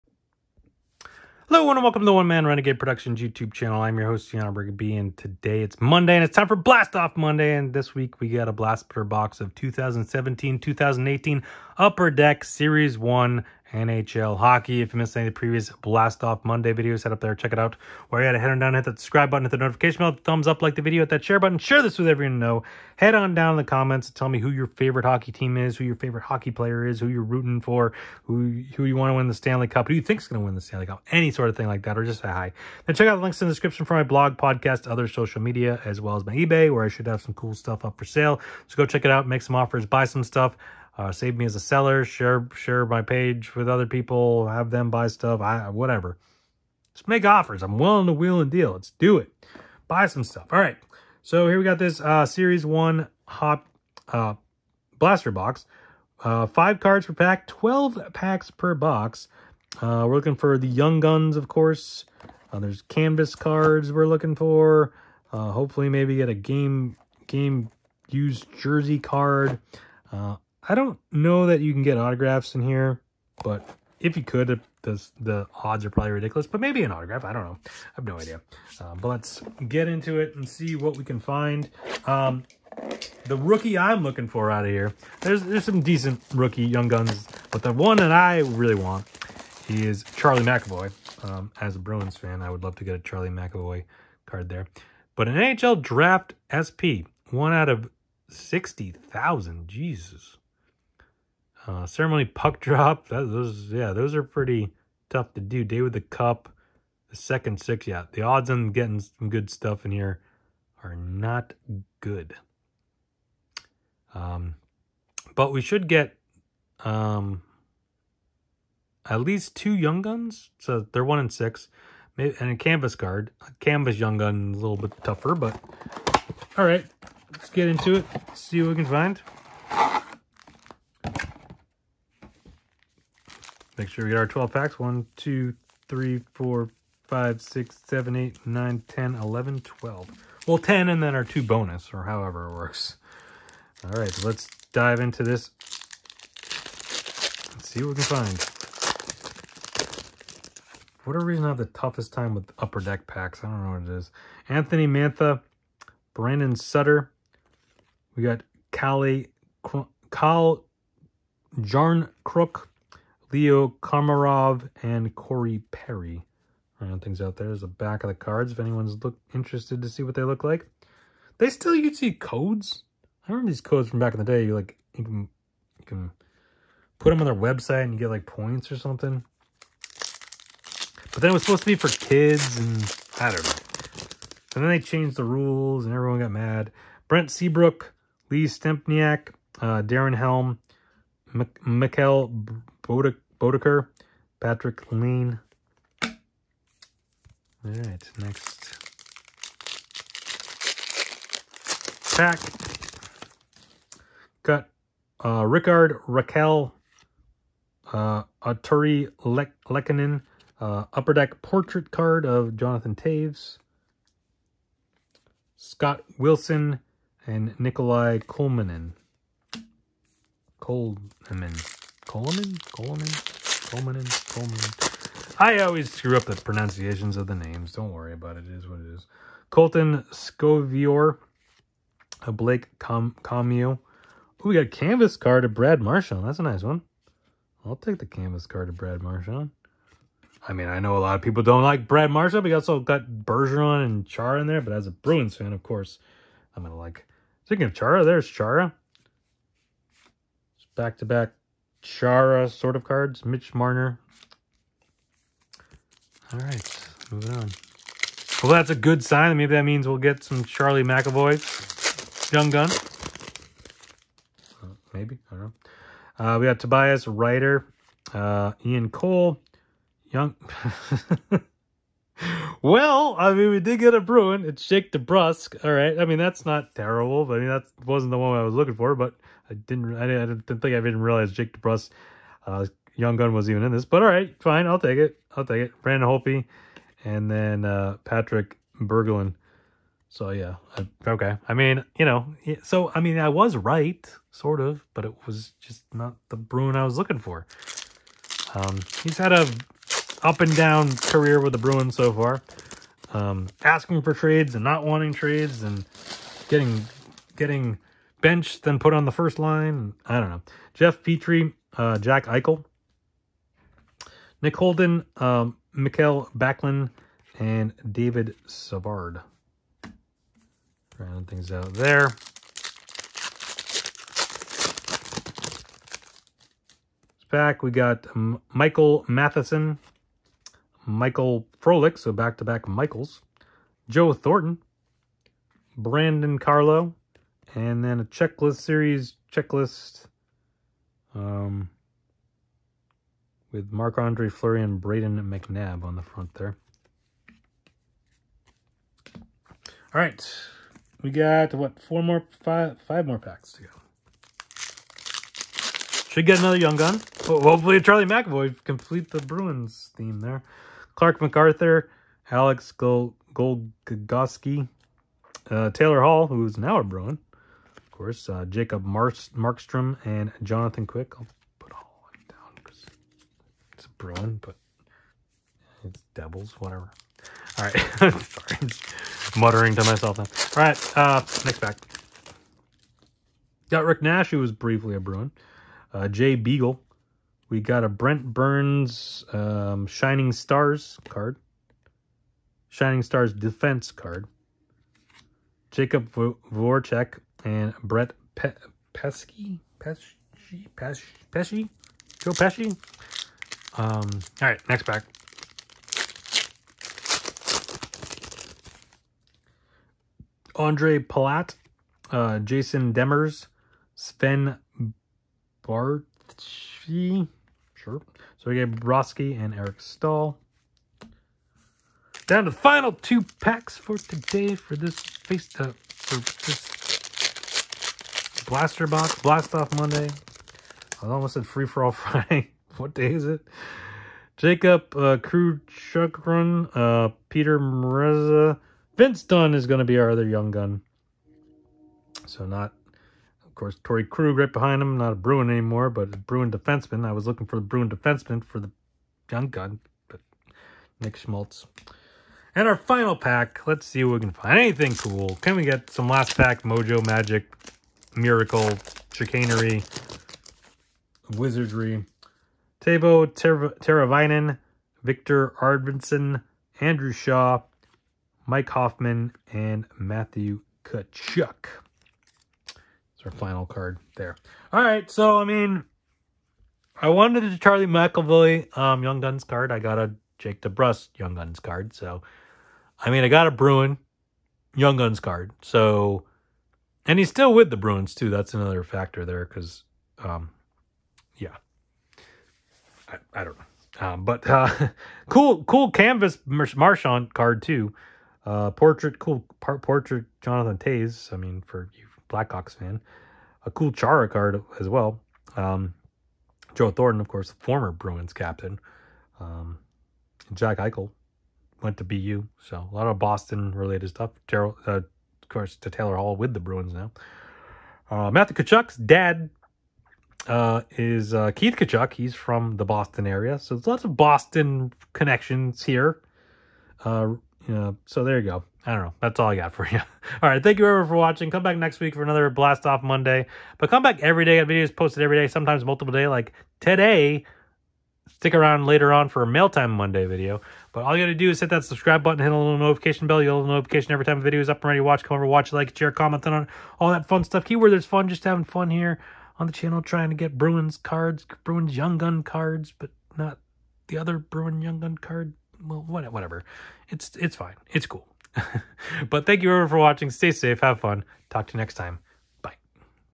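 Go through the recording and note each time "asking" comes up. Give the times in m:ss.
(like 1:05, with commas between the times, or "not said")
5:03.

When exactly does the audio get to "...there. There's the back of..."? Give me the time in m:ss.
2:47.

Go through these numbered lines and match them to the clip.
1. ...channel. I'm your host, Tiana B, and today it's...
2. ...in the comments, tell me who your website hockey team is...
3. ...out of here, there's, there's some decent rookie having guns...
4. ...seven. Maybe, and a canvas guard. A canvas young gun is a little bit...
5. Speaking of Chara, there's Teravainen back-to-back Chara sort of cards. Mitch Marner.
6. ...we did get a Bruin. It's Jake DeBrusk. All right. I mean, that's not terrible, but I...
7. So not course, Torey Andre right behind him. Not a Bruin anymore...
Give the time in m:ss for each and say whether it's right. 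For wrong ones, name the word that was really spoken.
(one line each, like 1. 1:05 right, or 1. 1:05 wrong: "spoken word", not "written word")
1. 0:03 right
2. 0:23 wrong: "favorite", not "website"
3. 1:24 wrong: "young", not "having"
4. 2:01 wrong: "six", not "seven"
5. 4:07 wrong: "Chara", not "Teravainen"
6. 4:33 right
7. 7:22 wrong: "Krug", not "Andre".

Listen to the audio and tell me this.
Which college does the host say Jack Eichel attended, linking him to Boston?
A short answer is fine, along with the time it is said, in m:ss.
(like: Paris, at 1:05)
BU, at 8:32.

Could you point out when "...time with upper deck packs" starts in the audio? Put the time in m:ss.
2:32.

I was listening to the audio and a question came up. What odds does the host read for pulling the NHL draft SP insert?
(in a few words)
1 in 60,000.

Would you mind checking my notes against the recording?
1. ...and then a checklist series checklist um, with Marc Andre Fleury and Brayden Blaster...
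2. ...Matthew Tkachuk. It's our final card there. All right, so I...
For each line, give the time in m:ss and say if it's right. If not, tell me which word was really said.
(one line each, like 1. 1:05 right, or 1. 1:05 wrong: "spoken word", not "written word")
1. 5:37 wrong: "McNabb", not "Blaster"
2. 7:49 right.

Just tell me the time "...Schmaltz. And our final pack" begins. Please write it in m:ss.
7:31.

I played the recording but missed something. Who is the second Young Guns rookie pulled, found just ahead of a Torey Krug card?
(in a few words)
Vince Dunn.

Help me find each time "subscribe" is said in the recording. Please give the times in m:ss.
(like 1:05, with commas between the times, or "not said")
0:18, 9:01.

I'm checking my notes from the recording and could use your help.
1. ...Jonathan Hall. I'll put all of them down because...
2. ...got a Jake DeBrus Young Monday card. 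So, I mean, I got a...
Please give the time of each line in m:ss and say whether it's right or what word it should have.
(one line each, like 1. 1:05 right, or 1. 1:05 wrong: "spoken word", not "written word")
1. 6:10 wrong: "Quick", not "Hall"
2. 7:59 wrong: "Guns", not "Monday".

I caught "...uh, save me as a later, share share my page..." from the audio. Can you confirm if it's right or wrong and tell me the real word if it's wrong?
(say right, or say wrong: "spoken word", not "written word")
wrong: "seller", not "later".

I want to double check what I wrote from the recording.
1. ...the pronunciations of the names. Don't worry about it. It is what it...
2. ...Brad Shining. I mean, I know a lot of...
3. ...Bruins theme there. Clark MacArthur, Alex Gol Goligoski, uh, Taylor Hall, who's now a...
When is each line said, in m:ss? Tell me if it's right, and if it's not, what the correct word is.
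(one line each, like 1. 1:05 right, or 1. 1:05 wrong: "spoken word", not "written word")
1. 3:46 right
2. 3:58 wrong: "Marchand", not "Shining"
3. 5:59 right.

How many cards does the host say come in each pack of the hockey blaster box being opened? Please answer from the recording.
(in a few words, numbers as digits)
5.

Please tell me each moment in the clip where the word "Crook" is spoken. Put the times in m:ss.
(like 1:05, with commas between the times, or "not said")
2:42.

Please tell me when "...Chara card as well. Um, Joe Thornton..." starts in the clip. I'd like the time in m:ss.
8:23.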